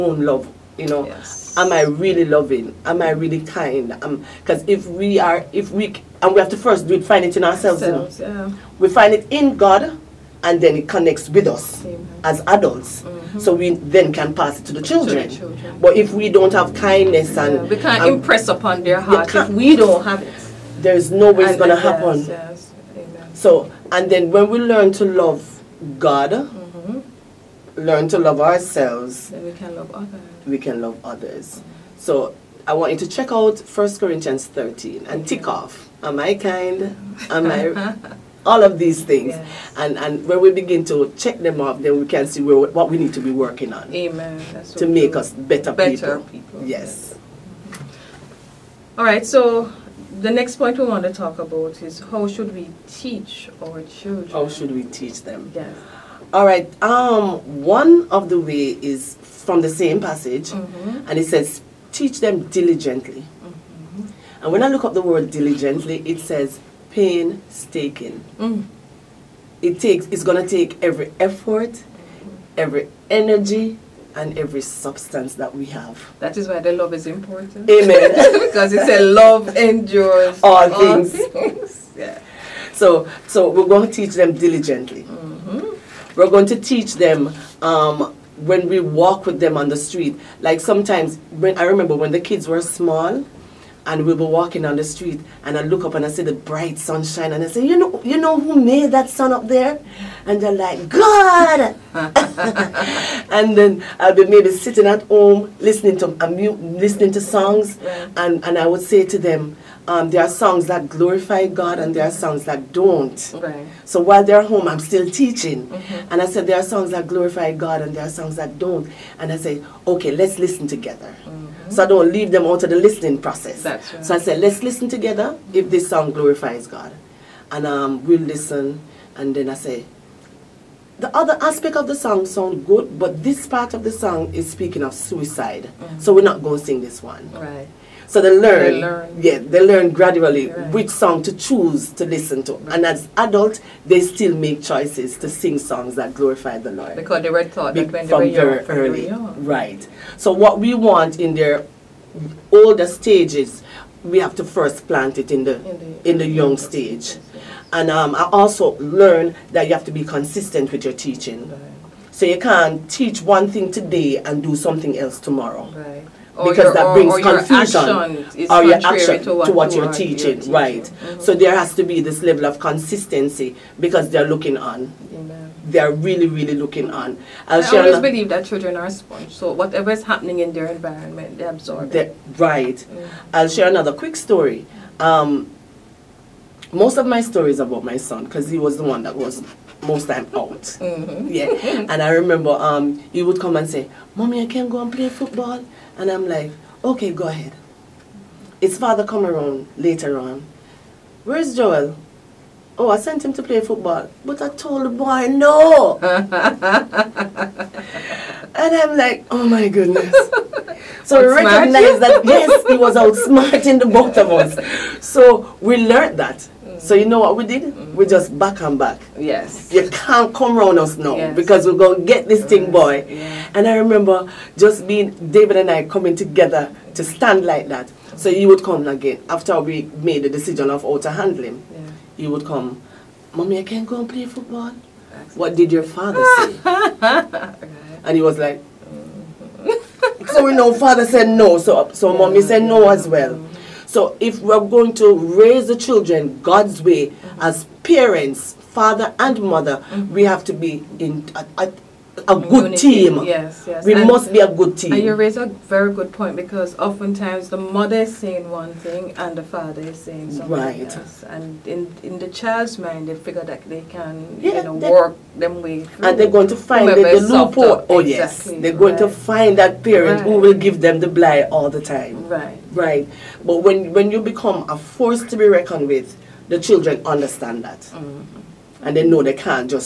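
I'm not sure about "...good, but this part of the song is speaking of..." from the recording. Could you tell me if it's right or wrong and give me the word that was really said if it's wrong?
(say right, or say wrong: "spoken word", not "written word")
right.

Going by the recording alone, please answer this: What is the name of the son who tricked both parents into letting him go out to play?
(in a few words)
Joel.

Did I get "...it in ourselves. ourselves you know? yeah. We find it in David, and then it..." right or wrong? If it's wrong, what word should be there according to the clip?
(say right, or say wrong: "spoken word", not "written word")
wrong: "God", not "David".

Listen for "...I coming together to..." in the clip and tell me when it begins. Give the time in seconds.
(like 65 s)
225 s.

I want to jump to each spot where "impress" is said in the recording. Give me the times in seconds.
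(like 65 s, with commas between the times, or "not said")
18 s.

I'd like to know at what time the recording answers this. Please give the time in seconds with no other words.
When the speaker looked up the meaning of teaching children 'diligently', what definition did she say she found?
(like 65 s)
66 s.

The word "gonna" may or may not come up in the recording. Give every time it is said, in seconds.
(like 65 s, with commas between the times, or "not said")
21 s, 221 s.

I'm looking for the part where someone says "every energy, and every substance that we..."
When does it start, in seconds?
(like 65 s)
72 s.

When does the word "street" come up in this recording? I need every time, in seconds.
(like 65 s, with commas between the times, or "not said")
89 s, 94 s.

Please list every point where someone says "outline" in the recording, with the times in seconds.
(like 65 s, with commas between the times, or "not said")
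not said.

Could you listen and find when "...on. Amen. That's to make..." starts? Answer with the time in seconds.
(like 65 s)
43 s.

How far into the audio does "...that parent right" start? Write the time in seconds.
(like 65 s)
269 s.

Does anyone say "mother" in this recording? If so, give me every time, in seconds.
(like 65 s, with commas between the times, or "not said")
249 s, 257 s.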